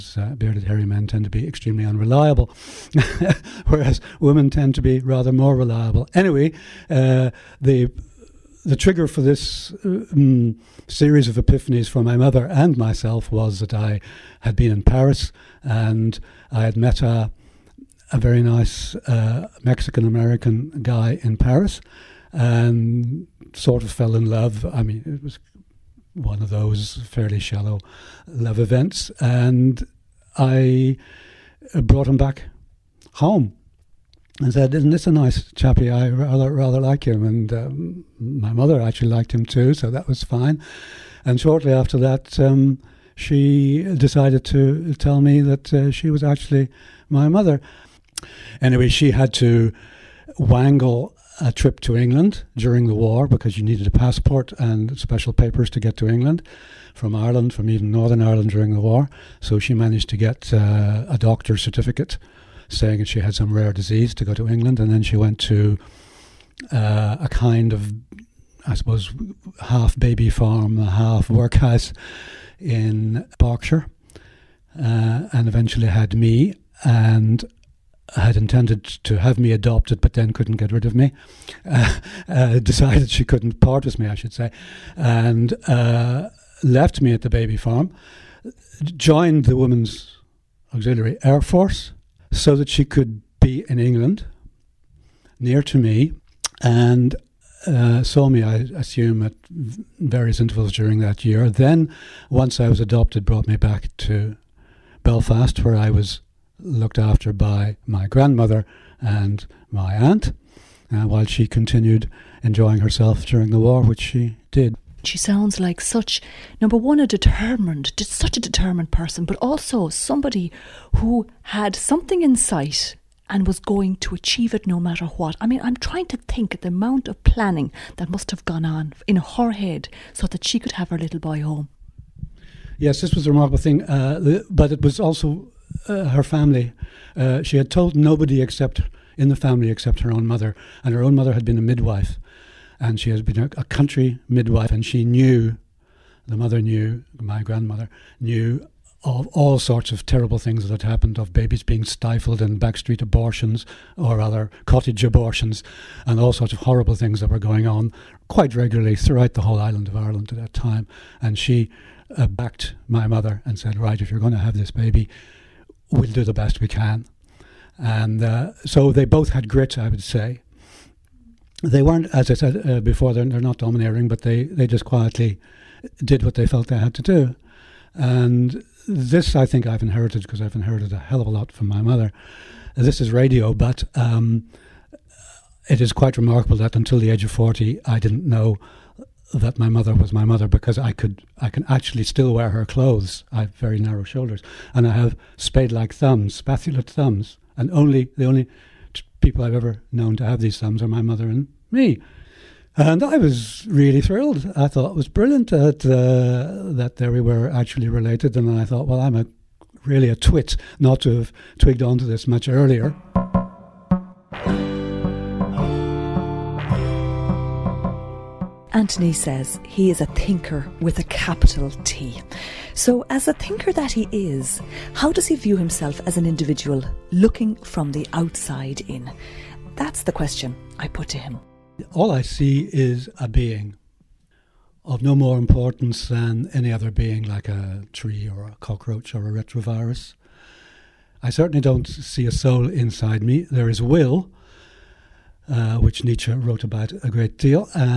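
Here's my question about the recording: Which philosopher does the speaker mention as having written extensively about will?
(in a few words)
Nietzsche.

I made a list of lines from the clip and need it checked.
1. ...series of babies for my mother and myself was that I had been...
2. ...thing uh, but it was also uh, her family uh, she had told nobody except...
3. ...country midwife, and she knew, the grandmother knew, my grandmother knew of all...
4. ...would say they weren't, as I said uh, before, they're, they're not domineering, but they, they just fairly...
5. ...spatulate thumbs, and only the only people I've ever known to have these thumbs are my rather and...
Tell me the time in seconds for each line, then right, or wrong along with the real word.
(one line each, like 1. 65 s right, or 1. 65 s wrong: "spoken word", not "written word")
1. 10 s wrong: "epiphanies", not "babies"
2. 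133 s right
3. 143 s wrong: "mother", not "grandmother"
4. 169 s wrong: "quietly", not "fairly"
5. 196 s wrong: "mother", not "rather".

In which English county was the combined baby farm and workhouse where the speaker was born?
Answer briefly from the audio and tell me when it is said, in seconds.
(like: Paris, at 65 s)
Berkshire, at 73 s.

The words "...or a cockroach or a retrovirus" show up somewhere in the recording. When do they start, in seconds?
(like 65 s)
238 s.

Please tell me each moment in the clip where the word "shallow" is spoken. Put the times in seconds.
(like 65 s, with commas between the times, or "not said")
27 s.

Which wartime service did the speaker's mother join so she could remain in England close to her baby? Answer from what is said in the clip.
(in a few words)
Women's Auxiliary Air Force.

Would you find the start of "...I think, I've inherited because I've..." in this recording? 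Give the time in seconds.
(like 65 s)
179 s.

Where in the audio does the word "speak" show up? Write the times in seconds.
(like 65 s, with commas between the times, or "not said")
not said.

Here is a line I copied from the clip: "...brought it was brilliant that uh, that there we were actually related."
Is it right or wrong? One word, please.
wrong.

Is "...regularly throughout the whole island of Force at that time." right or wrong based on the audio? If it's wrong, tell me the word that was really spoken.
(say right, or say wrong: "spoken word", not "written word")
wrong: "Ireland", not "Force".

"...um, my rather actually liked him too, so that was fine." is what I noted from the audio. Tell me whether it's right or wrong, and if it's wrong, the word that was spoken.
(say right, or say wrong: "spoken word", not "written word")
wrong: "mother", not "rather".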